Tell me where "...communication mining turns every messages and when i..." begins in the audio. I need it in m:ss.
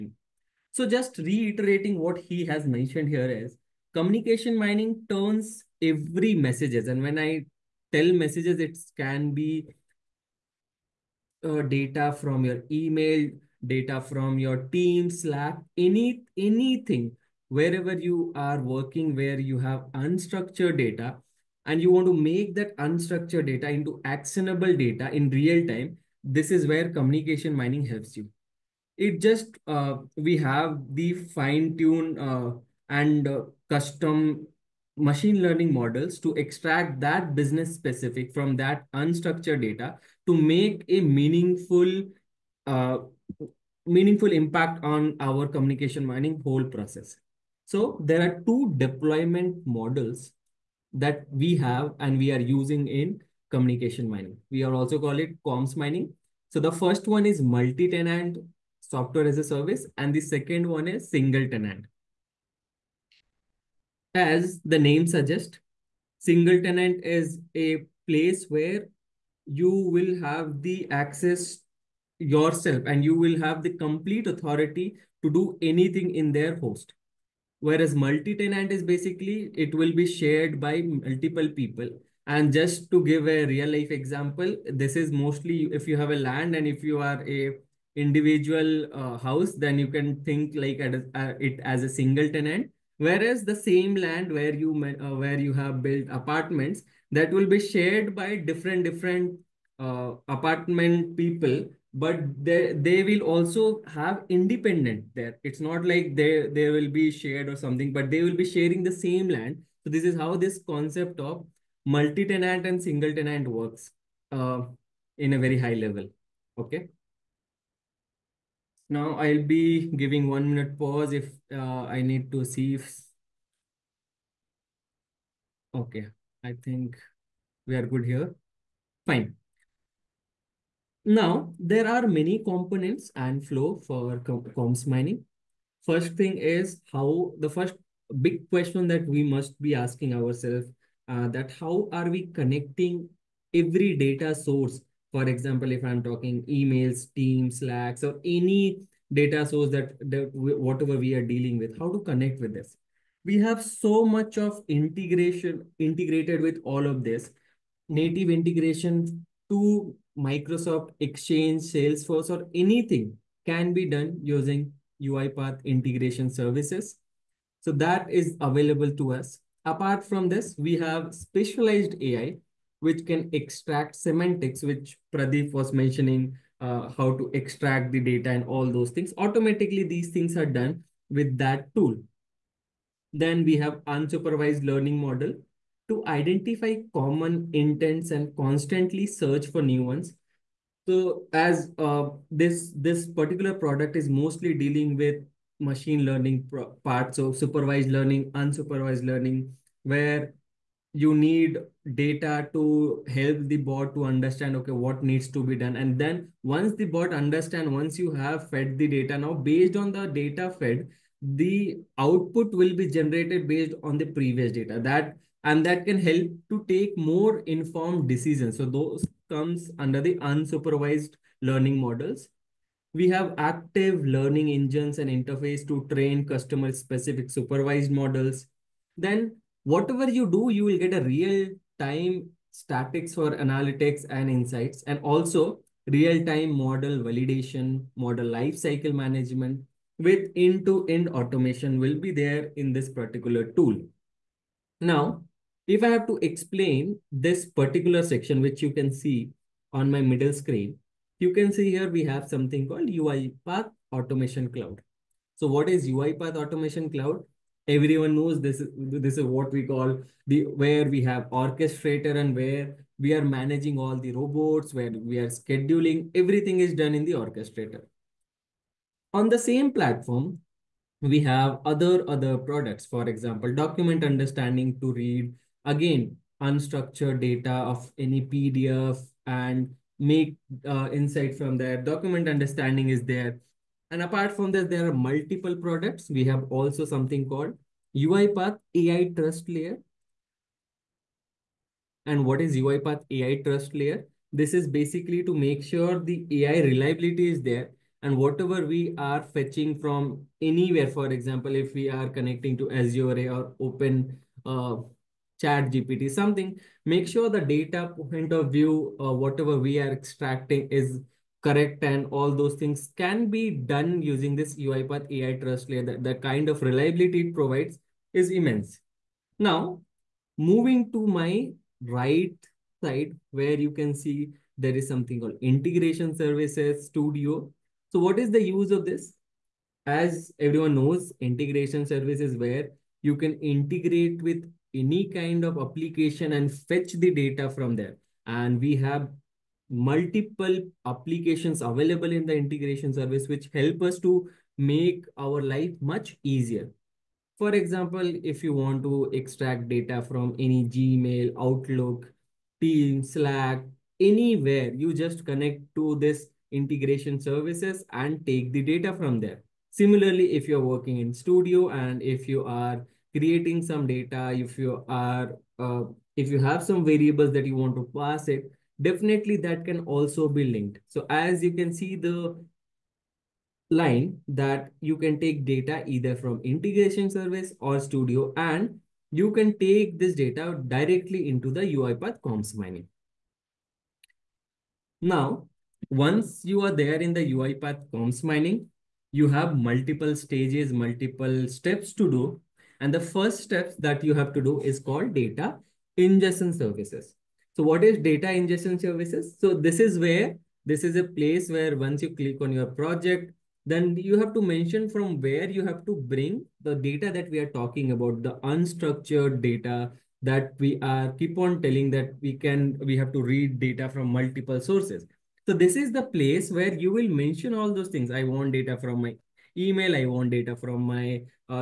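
0:03.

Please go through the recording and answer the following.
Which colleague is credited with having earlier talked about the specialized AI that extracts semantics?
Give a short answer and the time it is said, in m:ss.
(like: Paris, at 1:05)
Pradeep, at 2:55.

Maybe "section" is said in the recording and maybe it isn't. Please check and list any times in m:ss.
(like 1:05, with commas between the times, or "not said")
4:08.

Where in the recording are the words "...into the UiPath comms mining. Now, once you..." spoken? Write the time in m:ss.
6:21.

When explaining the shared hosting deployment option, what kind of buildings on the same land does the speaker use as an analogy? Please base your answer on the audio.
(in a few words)
apartments.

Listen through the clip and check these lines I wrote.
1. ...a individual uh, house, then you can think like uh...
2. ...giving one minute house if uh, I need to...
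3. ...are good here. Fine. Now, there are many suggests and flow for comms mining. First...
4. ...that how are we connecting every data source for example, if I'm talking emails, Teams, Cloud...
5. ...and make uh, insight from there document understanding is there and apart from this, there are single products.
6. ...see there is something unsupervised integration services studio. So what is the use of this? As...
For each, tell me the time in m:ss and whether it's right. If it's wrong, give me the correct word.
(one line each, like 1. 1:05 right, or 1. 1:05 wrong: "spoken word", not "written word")
1. 1:27 right
2. 1:59 wrong: "pause", not "house"
3. 2:07 wrong: "components", not "suggests"
4. 2:21 wrong: "Slacks", not "Cloud"
5. 4:39 wrong: "multiple", not "single"
6. 5:23 wrong: "called", not "unsupervised".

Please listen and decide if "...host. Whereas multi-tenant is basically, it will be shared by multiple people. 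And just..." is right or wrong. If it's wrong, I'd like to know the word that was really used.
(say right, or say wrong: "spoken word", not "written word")
right.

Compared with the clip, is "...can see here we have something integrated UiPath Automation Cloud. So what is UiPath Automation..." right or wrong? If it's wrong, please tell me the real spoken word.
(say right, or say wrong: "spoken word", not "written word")
wrong: "called", not "integrated".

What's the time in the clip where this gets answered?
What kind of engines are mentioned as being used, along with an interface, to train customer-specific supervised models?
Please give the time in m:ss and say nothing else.
3:43.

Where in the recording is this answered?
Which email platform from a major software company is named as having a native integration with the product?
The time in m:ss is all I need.
2:40.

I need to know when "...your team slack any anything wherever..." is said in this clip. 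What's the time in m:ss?
0:14.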